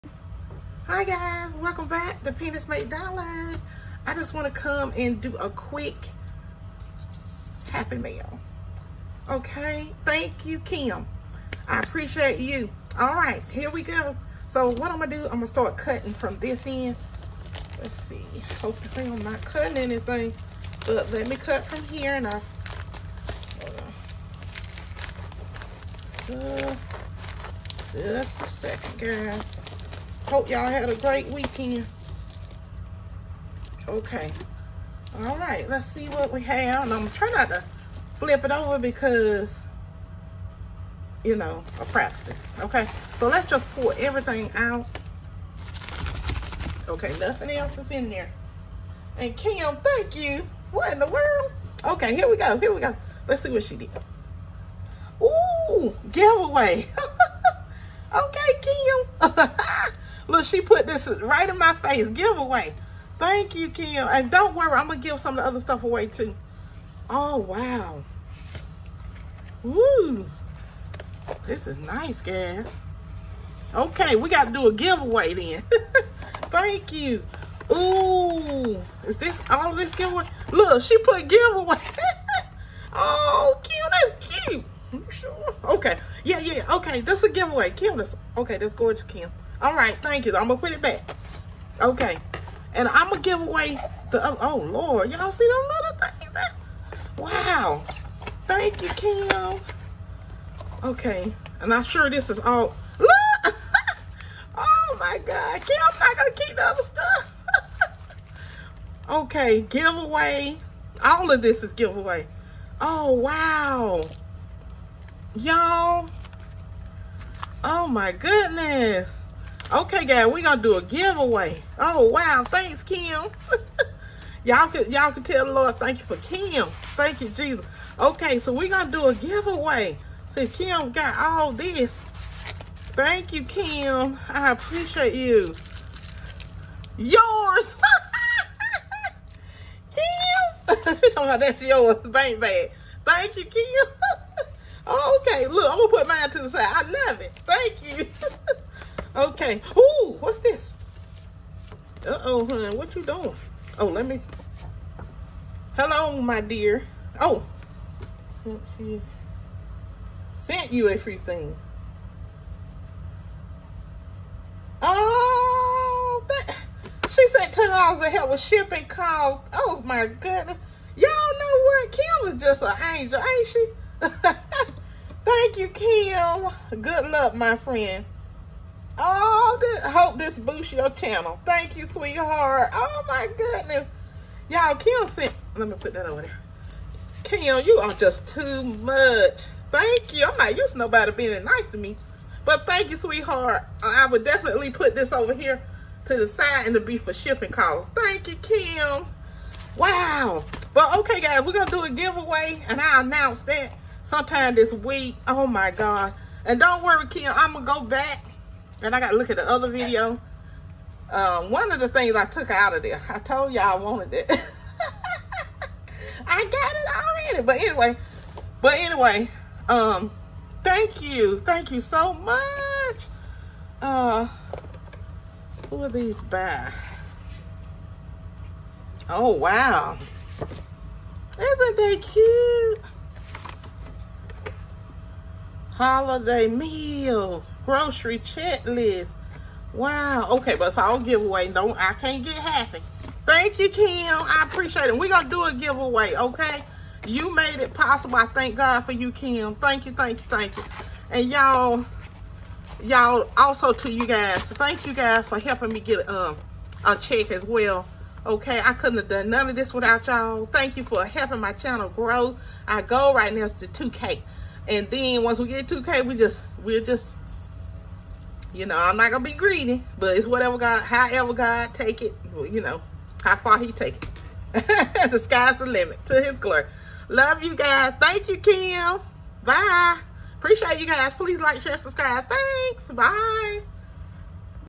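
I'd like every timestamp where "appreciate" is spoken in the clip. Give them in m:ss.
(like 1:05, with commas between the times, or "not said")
0:11, 2:14, 4:04, 4:40.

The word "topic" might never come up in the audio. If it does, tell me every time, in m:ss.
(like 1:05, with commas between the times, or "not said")
not said.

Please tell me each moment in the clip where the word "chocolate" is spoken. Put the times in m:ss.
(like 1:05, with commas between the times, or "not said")
not said.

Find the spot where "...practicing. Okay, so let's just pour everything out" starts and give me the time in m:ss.
0:41.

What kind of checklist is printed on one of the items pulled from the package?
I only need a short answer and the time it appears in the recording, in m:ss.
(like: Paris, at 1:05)
Holiday meal grocery checklist, at 3:55.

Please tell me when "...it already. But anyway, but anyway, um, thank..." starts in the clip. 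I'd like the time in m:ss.
3:36.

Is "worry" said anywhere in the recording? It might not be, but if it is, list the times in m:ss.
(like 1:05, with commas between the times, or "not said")
1:04, 3:26.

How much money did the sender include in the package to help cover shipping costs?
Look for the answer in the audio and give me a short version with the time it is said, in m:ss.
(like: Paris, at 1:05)
$10, at 2:47.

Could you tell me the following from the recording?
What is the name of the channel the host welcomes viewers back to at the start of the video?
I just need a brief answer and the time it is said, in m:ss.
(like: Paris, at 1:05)
Pennies Make Dollars, at 0:02.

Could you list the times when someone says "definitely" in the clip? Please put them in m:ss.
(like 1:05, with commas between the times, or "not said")
3:14.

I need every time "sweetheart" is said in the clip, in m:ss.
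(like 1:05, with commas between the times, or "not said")
3:01, 3:12.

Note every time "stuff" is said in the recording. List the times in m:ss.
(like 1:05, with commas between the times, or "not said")
1:05, 1:46.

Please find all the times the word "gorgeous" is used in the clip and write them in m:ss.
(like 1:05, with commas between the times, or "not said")
1:28.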